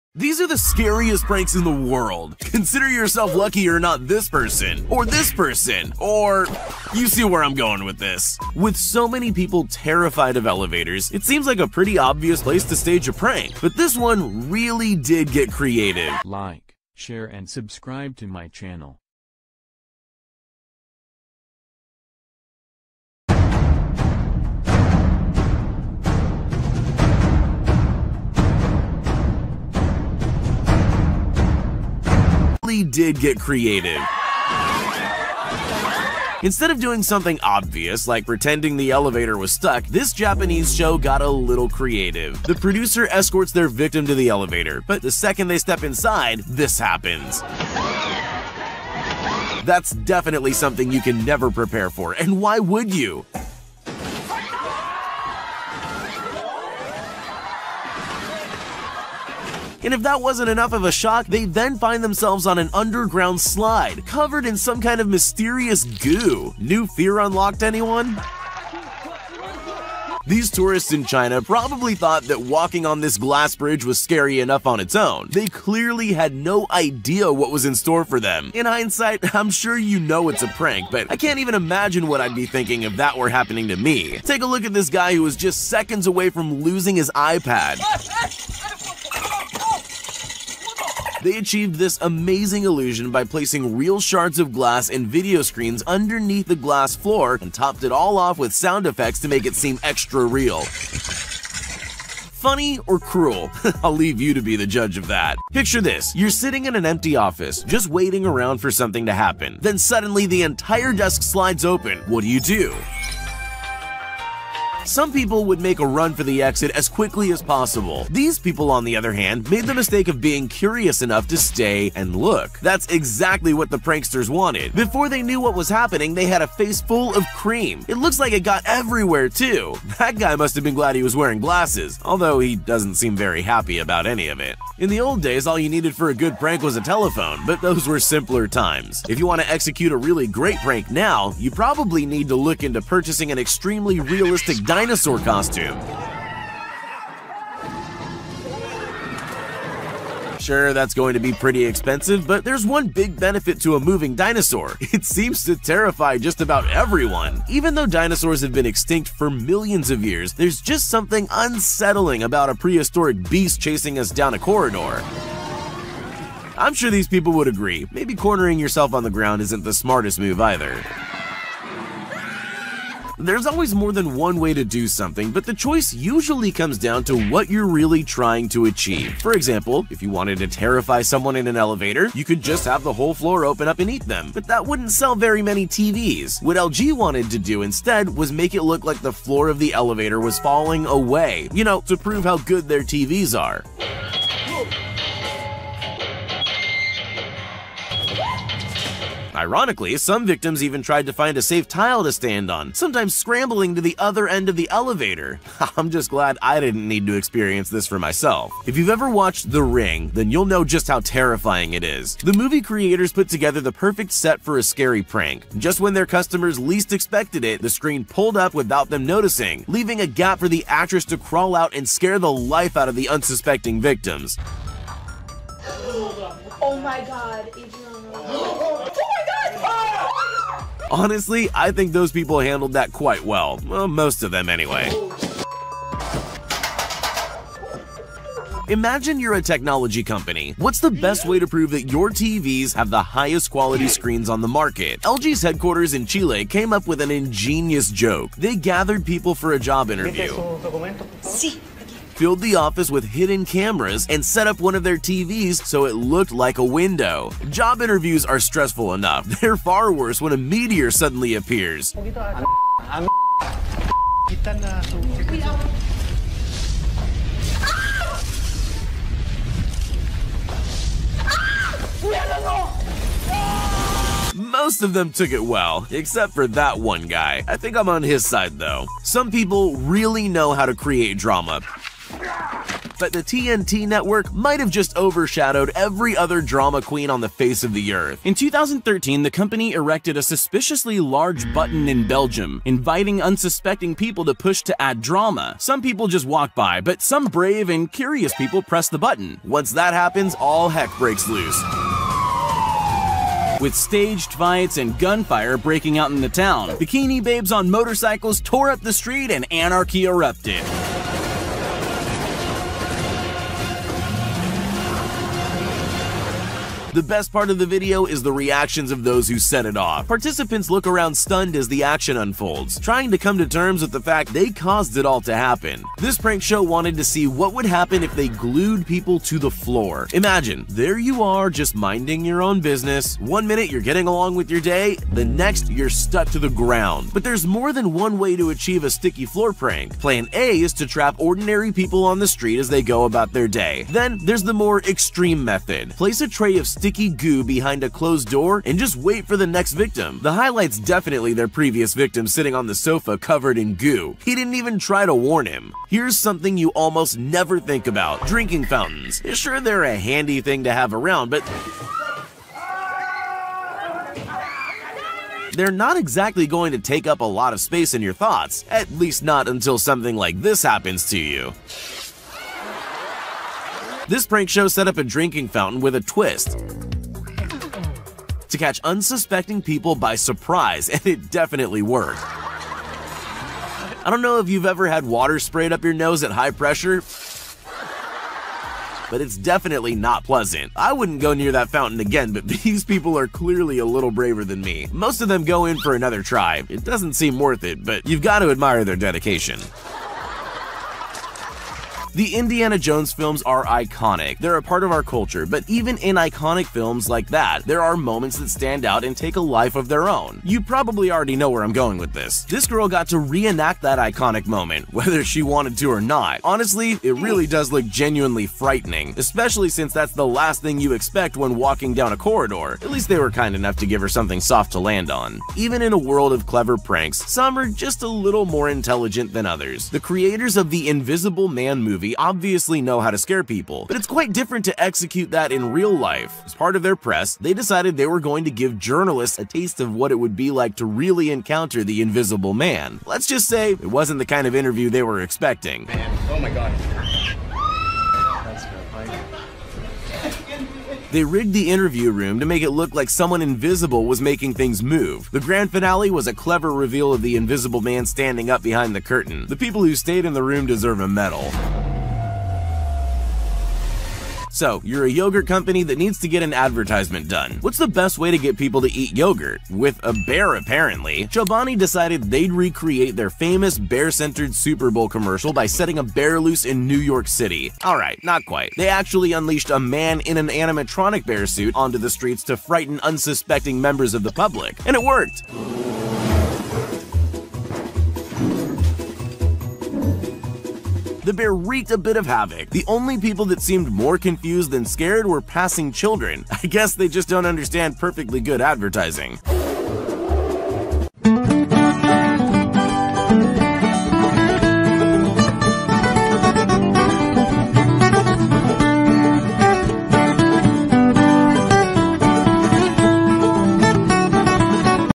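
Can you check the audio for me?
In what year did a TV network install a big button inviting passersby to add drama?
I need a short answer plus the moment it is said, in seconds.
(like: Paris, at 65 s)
2013, at 288 s.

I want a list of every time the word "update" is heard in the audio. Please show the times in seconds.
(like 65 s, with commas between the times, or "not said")
not said.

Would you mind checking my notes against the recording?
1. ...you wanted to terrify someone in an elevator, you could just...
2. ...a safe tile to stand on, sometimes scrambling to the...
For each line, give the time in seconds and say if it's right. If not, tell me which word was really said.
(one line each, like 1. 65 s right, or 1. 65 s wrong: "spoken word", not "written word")
1. 180 s right
2. 201 s right.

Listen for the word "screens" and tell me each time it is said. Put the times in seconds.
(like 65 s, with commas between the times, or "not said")
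95 s, 217 s, 243 s.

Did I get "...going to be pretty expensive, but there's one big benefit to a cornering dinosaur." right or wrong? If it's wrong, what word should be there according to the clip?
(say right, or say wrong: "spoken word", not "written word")
wrong: "moving", not "cornering".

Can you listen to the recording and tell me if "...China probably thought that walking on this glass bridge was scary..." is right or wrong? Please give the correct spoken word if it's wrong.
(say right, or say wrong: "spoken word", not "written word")
right.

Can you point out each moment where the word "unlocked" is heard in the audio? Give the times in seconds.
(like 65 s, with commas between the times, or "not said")
67 s.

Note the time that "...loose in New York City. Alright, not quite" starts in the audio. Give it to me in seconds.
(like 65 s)
476 s.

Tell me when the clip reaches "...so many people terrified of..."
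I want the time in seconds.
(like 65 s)
8 s.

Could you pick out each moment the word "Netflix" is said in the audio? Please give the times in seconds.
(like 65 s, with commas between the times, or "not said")
not said.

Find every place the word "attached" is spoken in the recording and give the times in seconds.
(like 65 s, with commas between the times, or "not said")
not said.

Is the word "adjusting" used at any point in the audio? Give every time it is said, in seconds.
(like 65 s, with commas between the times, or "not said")
not said.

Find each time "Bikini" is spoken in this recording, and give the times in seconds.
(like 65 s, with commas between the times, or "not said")
306 s.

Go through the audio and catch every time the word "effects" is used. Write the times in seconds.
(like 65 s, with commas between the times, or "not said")
98 s.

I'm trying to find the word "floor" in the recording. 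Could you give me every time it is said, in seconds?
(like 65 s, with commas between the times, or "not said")
96 s, 183 s, 189 s, 329 s, 339 s.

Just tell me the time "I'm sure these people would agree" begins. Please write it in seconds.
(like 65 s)
166 s.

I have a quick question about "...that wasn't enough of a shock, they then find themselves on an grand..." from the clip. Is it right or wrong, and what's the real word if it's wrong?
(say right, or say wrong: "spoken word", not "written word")
wrong: "underground", not "grand".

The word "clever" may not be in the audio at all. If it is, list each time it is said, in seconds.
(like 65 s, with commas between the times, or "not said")
426 s, 456 s.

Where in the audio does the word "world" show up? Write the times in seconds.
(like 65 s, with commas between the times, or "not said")
1 s, 425 s.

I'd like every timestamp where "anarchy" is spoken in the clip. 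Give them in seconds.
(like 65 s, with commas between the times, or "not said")
309 s.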